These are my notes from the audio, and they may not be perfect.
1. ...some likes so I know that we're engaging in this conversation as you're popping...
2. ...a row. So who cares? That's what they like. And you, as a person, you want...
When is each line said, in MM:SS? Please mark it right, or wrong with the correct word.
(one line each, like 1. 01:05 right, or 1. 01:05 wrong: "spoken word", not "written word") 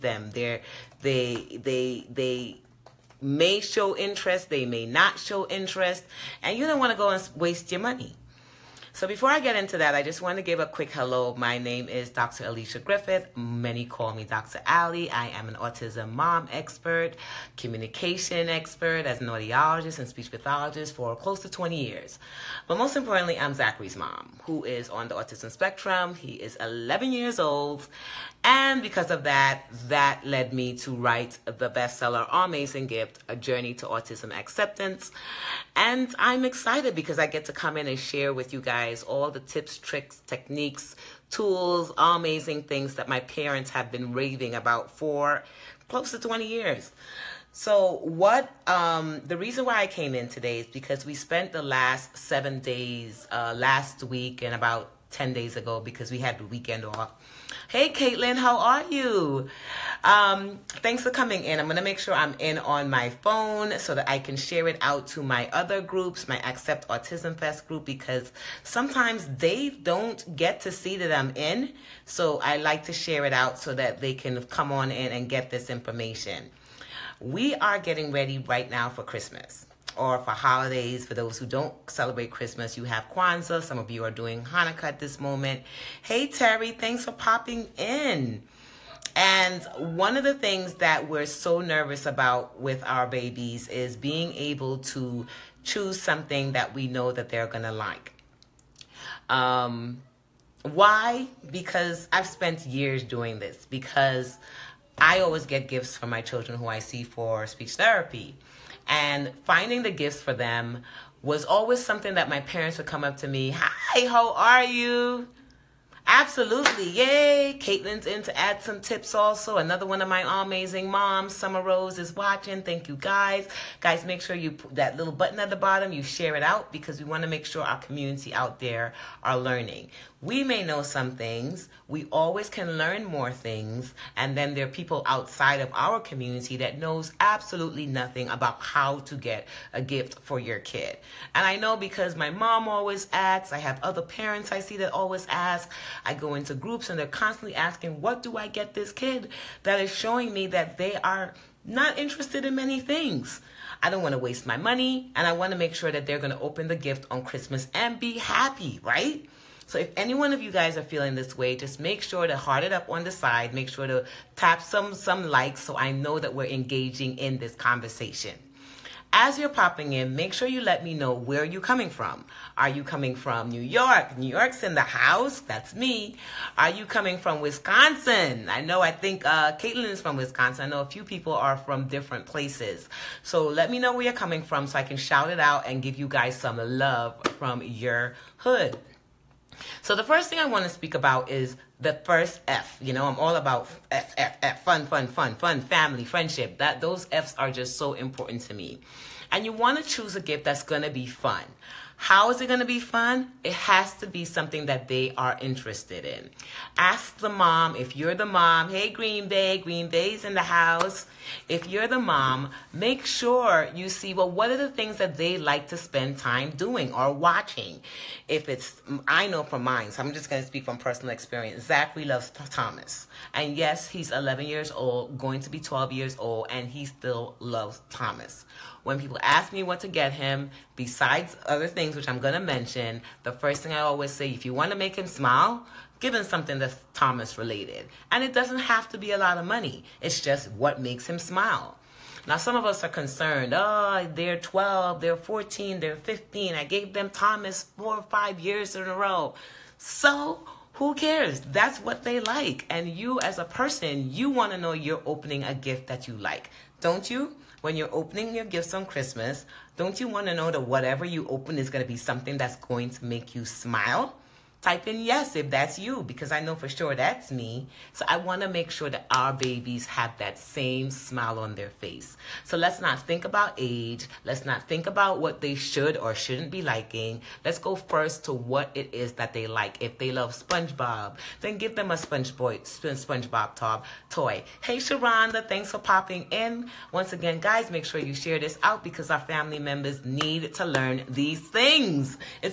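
1. 02:44 right
2. 04:08 right.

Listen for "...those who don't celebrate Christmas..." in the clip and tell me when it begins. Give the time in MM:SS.
01:21.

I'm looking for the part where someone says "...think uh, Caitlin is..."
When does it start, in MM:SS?
02:58.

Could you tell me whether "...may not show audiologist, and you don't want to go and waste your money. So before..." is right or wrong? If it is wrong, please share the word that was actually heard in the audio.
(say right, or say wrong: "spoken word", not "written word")
wrong: "interest", not "audiologist".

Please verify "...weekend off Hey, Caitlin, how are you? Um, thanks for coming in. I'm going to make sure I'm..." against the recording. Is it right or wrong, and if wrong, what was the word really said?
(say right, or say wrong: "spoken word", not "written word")
right.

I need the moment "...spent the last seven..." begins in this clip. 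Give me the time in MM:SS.
00:51.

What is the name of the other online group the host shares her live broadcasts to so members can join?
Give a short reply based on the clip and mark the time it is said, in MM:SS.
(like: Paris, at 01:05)
Accept Autism Fest, at 01:06.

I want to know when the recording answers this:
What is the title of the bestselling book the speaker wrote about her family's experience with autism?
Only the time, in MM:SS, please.
00:32.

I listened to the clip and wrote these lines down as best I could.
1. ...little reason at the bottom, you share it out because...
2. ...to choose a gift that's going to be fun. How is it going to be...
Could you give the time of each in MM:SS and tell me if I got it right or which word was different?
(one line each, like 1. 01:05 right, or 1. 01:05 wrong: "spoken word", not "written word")
1. 02:04 wrong: "button", not "reason"
2. 03:19 right.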